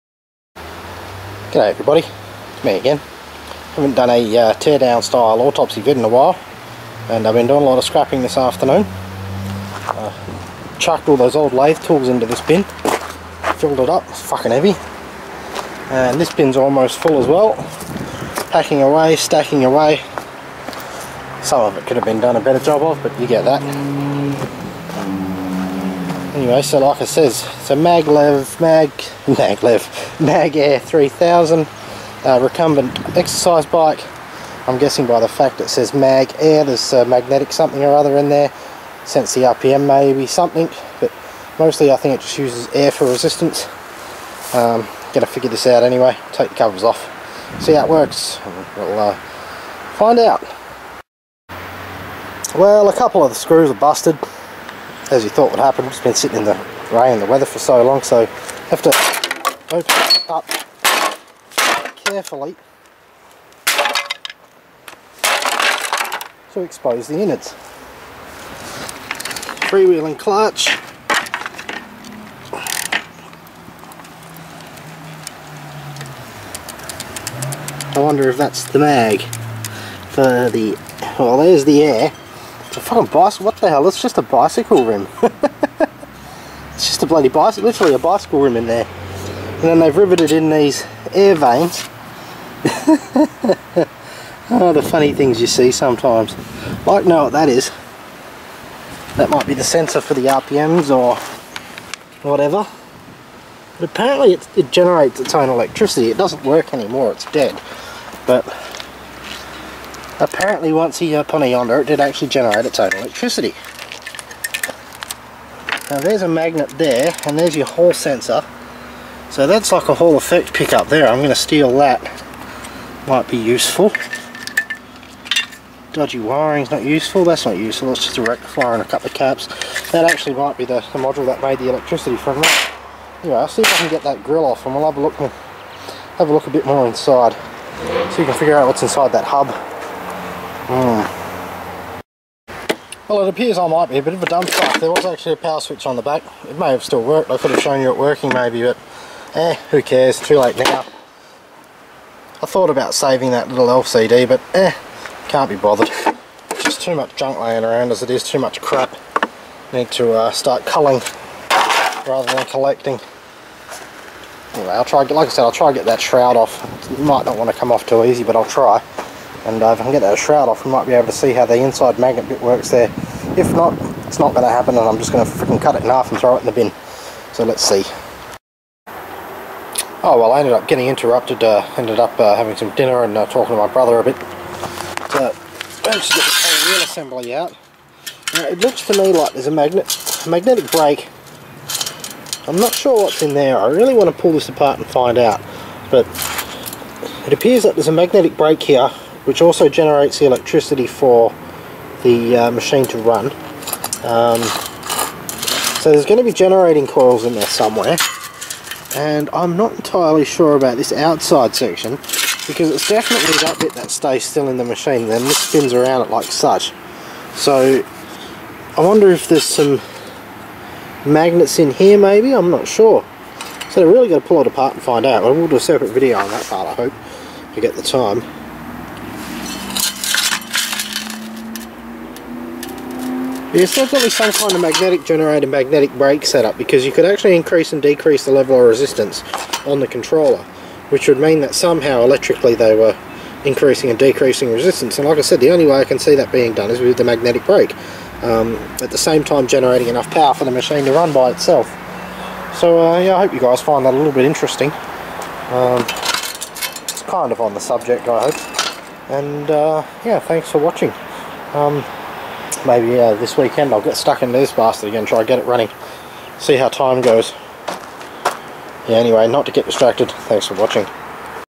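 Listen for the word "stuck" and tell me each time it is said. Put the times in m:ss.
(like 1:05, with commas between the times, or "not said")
4:23.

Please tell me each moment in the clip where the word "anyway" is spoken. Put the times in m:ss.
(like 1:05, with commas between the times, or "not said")
0:26, 0:45, 2:13, 2:44, 4:28.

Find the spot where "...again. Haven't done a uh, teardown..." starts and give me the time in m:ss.
0:02.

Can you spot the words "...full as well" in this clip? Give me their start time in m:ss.
0:16.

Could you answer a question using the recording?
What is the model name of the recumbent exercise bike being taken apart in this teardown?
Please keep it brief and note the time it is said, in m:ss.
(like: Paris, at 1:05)
Mag Air 3000, at 0:30.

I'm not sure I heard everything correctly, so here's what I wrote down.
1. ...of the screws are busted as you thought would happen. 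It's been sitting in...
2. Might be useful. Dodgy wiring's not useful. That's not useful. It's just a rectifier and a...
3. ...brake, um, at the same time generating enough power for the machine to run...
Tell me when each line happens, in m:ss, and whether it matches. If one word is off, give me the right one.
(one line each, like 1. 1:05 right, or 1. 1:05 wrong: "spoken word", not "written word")
1. 0:53 right
2. 2:03 right
3. 4:07 right.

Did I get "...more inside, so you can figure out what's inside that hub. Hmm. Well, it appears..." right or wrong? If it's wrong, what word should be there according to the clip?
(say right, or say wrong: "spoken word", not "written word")
right.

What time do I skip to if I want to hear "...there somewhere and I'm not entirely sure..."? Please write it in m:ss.
3:27.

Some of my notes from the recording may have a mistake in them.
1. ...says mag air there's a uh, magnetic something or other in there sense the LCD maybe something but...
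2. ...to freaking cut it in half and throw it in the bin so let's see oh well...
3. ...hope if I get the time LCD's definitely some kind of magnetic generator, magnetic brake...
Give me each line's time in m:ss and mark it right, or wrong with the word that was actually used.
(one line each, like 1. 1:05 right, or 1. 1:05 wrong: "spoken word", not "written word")
1. 0:35 wrong: "RPM", not "LCD"
2. 2:55 right
3. 3:46 wrong: "There", not "LCD".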